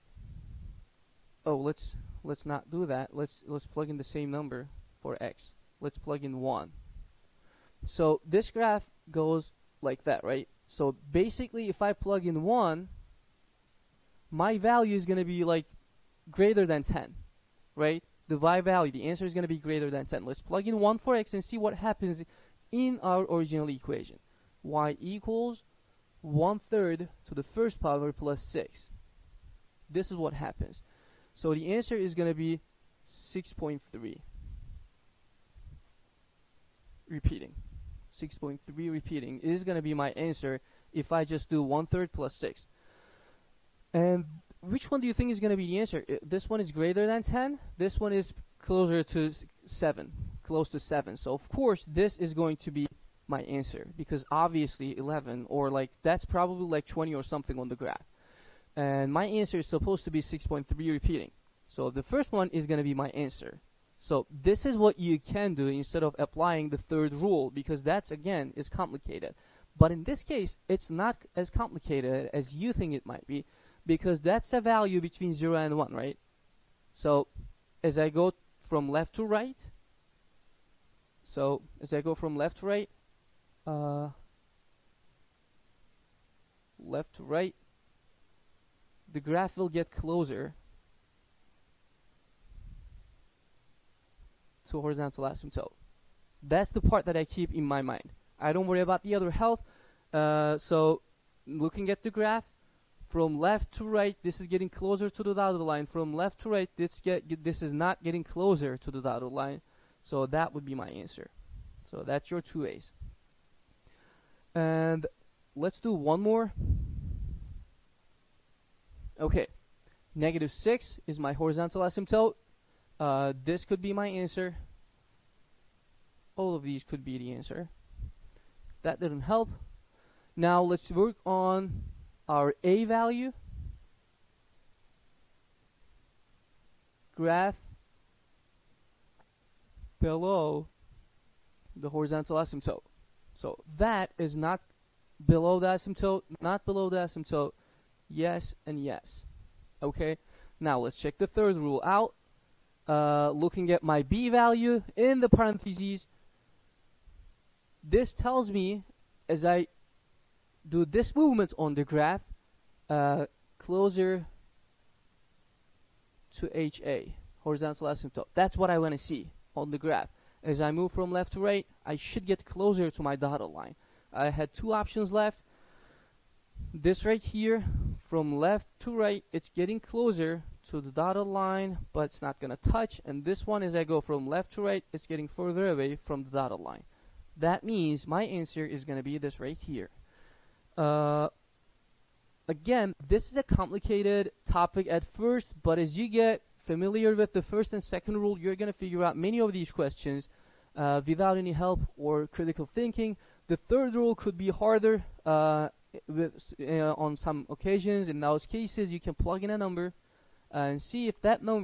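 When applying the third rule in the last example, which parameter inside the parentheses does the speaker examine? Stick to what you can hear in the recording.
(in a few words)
b value.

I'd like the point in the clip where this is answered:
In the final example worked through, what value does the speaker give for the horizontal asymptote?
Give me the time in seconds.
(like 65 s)
120 s.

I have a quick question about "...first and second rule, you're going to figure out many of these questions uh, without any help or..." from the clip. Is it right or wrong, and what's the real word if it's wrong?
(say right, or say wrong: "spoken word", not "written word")
right.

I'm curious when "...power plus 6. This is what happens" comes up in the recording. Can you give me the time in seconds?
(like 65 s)
27 s.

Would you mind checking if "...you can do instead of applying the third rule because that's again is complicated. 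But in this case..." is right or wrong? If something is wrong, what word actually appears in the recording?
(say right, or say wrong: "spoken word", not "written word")
right.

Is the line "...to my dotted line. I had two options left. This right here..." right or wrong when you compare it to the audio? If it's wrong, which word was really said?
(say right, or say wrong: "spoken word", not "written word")
right.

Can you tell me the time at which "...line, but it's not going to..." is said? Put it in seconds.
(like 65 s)
181 s.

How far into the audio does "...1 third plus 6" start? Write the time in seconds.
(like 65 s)
41 s.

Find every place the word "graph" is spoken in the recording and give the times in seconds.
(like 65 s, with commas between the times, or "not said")
8 s, 57 s, 89 s, 102 s, 137 s, 161 s, 169 s.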